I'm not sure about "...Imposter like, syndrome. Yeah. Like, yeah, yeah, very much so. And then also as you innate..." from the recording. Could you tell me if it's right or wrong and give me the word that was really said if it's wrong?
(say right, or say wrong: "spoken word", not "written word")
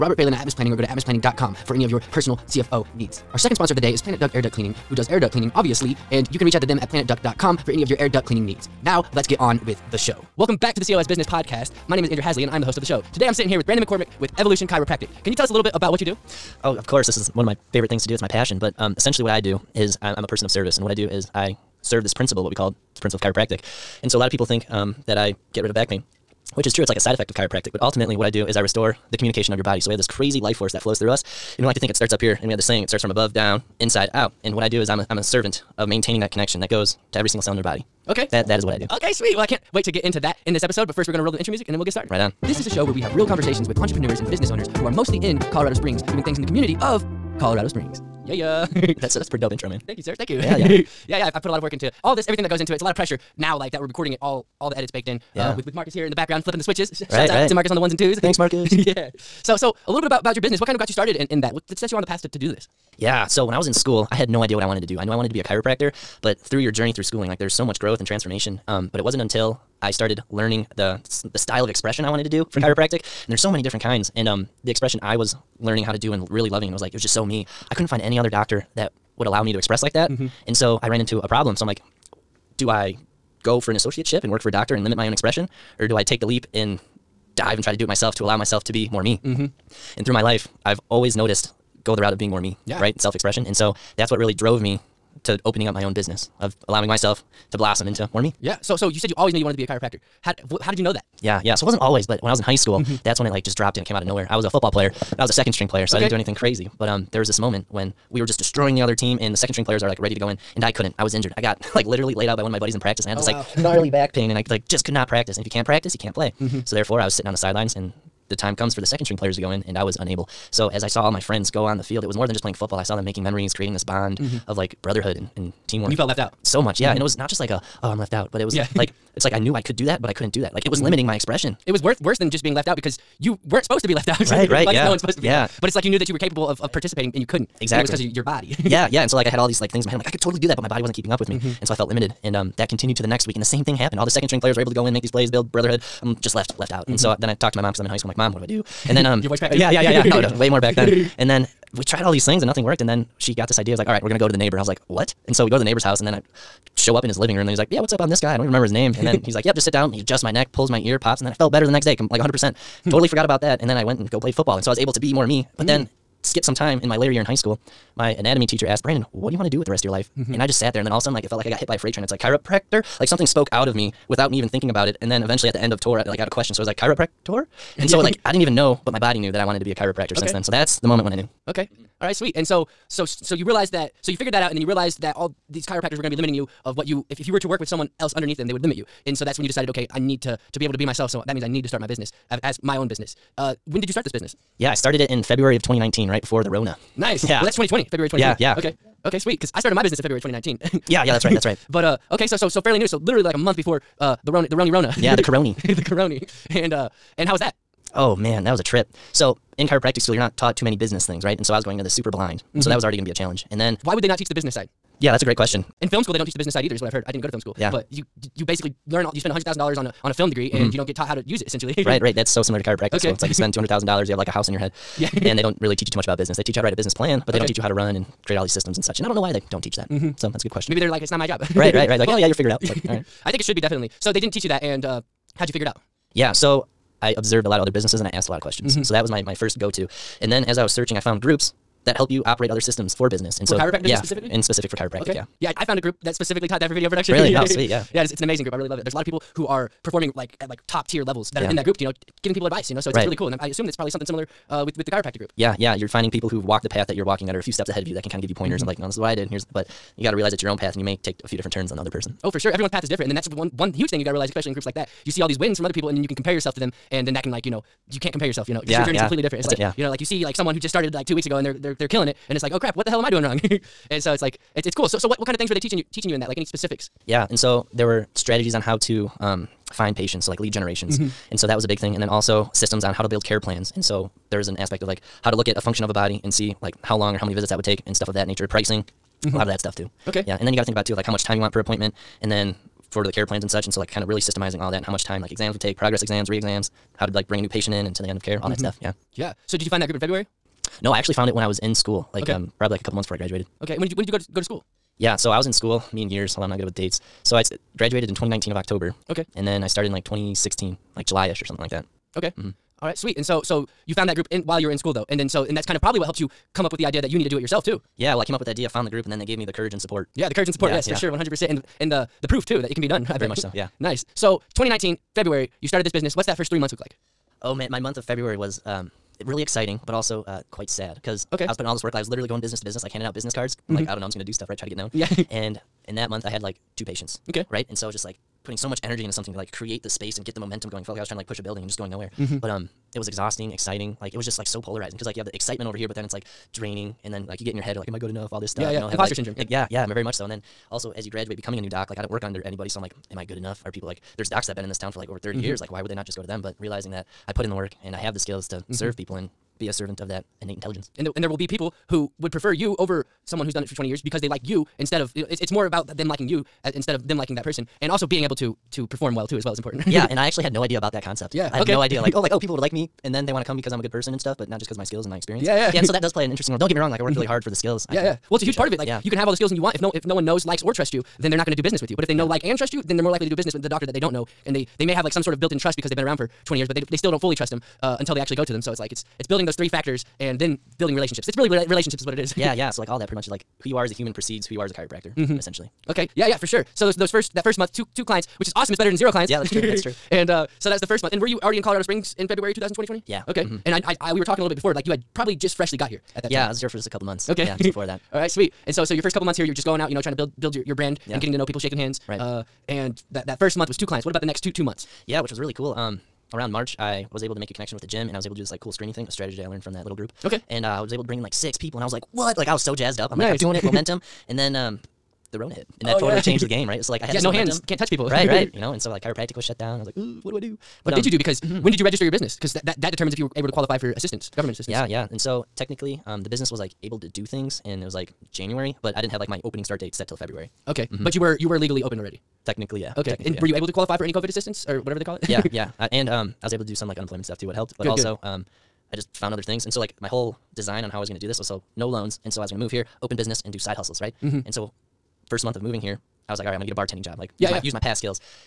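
wrong: "graduate", not "innate".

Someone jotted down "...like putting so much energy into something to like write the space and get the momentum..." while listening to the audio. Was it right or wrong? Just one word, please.
wrong.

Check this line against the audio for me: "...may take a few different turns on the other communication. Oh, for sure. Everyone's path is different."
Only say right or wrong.
wrong.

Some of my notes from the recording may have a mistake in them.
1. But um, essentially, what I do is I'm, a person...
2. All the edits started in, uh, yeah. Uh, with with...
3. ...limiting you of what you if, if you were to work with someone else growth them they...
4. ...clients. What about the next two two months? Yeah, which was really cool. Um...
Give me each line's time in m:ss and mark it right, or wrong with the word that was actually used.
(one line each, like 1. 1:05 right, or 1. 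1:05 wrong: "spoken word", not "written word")
1. 0:18 right
2. 0:54 wrong: "baked", not "started"
3. 3:06 wrong: "underneath", not "growth"
4. 6:53 right.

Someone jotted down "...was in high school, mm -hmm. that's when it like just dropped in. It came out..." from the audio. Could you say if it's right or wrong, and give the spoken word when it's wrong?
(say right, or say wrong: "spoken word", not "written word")
right.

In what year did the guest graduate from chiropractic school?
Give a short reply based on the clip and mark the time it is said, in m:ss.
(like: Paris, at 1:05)
2019, at 5:07.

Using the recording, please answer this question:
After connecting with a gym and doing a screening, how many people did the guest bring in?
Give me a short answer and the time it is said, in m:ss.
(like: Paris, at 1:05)
6, at 7:01.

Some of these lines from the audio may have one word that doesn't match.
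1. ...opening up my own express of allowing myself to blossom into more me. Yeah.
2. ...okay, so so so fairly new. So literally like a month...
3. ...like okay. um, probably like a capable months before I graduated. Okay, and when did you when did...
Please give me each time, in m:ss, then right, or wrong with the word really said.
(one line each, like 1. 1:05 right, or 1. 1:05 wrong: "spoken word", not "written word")
1. 1:35 wrong: "business", not "express"
2. 3:22 right
3. 5:02 wrong: "couple", not "capable".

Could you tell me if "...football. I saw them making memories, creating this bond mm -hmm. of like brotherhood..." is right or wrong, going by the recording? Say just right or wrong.
right.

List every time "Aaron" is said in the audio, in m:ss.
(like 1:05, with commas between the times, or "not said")
not said.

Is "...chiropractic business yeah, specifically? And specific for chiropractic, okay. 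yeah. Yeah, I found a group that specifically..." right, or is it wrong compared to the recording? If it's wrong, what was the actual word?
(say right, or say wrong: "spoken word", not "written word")
right.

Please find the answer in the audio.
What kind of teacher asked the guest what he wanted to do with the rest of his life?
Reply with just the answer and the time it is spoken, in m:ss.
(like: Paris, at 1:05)
Anatomy teacher, at 2:47.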